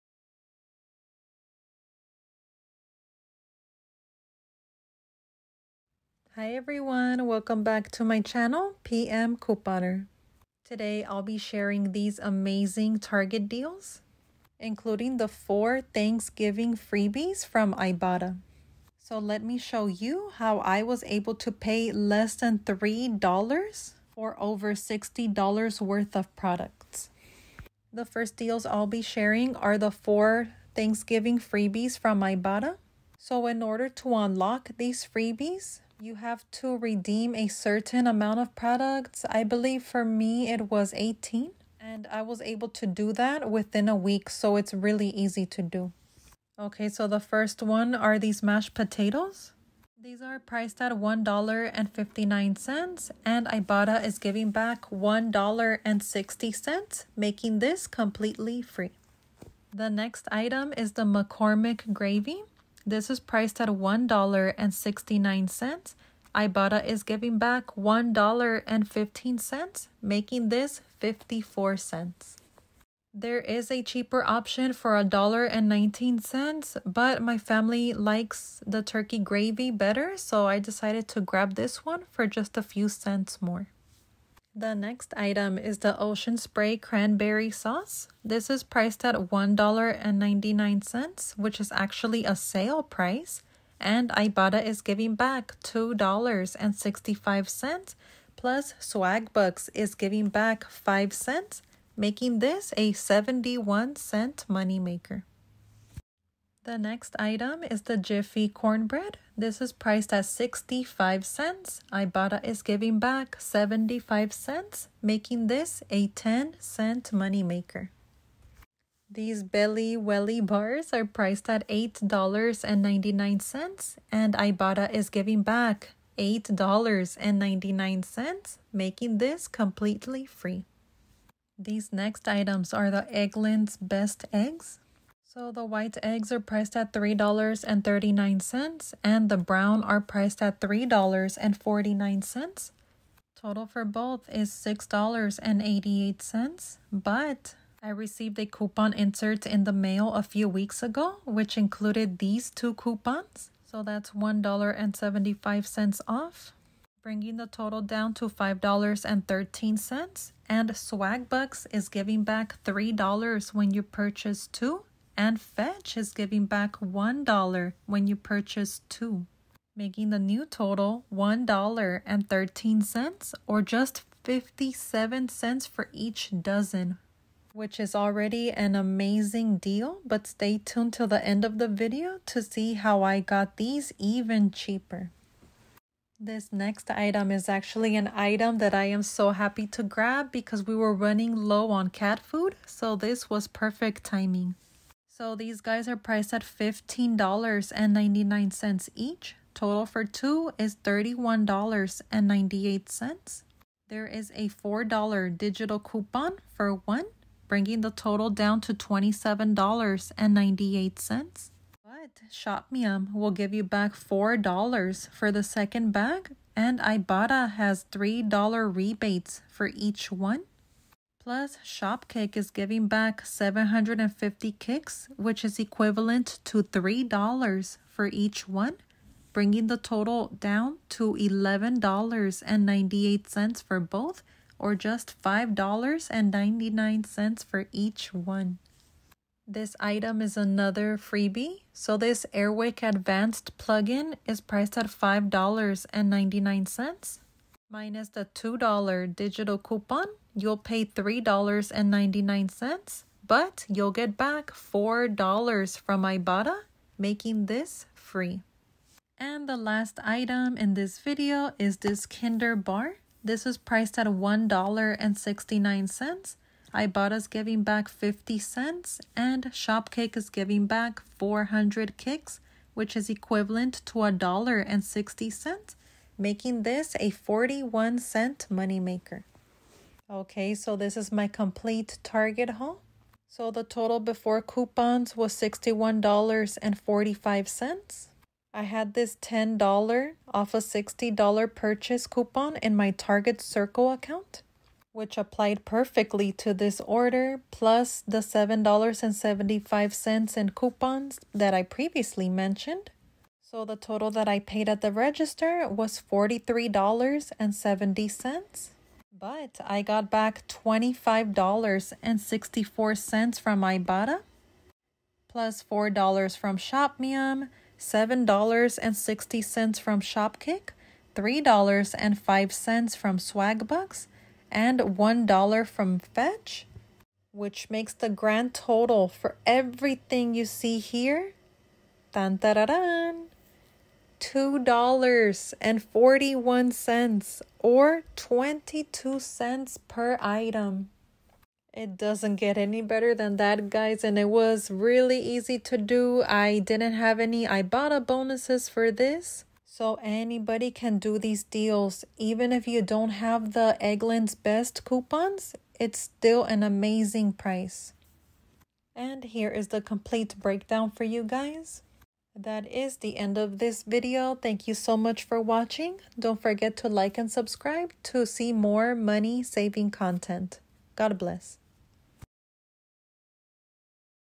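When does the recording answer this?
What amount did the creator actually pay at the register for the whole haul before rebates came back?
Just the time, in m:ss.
5:06.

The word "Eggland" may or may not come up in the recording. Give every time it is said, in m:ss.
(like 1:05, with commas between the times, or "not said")
2:13, 5:53.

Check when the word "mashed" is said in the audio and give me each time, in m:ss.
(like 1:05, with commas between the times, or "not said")
0:48.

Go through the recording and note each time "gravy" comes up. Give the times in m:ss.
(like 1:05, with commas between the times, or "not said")
1:01, 1:19.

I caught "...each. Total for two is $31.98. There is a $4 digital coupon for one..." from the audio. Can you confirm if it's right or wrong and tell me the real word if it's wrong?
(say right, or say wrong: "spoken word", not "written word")
right.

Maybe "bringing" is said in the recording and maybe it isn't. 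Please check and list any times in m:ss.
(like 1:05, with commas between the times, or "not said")
2:37, 3:27, 3:49.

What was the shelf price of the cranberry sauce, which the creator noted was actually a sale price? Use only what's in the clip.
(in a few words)
$1.99.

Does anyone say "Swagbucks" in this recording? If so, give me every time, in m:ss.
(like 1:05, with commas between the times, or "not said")
1:38, 2:40, 5:23.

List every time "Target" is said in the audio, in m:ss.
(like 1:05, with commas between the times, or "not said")
0:12, 4:42, 4:52.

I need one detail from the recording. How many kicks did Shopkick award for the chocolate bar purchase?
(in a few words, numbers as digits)
400.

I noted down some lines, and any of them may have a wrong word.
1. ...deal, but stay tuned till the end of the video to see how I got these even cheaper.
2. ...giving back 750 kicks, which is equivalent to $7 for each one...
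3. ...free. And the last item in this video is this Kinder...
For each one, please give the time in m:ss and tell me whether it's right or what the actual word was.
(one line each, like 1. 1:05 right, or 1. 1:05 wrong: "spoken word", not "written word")
1. 2:59 right
2. 3:42 wrong: "3", not "7"
3. 4:17 right.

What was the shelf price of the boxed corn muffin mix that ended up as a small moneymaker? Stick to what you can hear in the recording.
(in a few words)
65 cents.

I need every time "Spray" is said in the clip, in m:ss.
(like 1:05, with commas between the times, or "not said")
1:26.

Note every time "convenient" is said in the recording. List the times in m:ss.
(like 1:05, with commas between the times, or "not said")
not said.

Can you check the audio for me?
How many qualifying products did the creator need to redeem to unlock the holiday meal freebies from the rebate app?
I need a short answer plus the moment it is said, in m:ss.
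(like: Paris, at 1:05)
18, at 0:40.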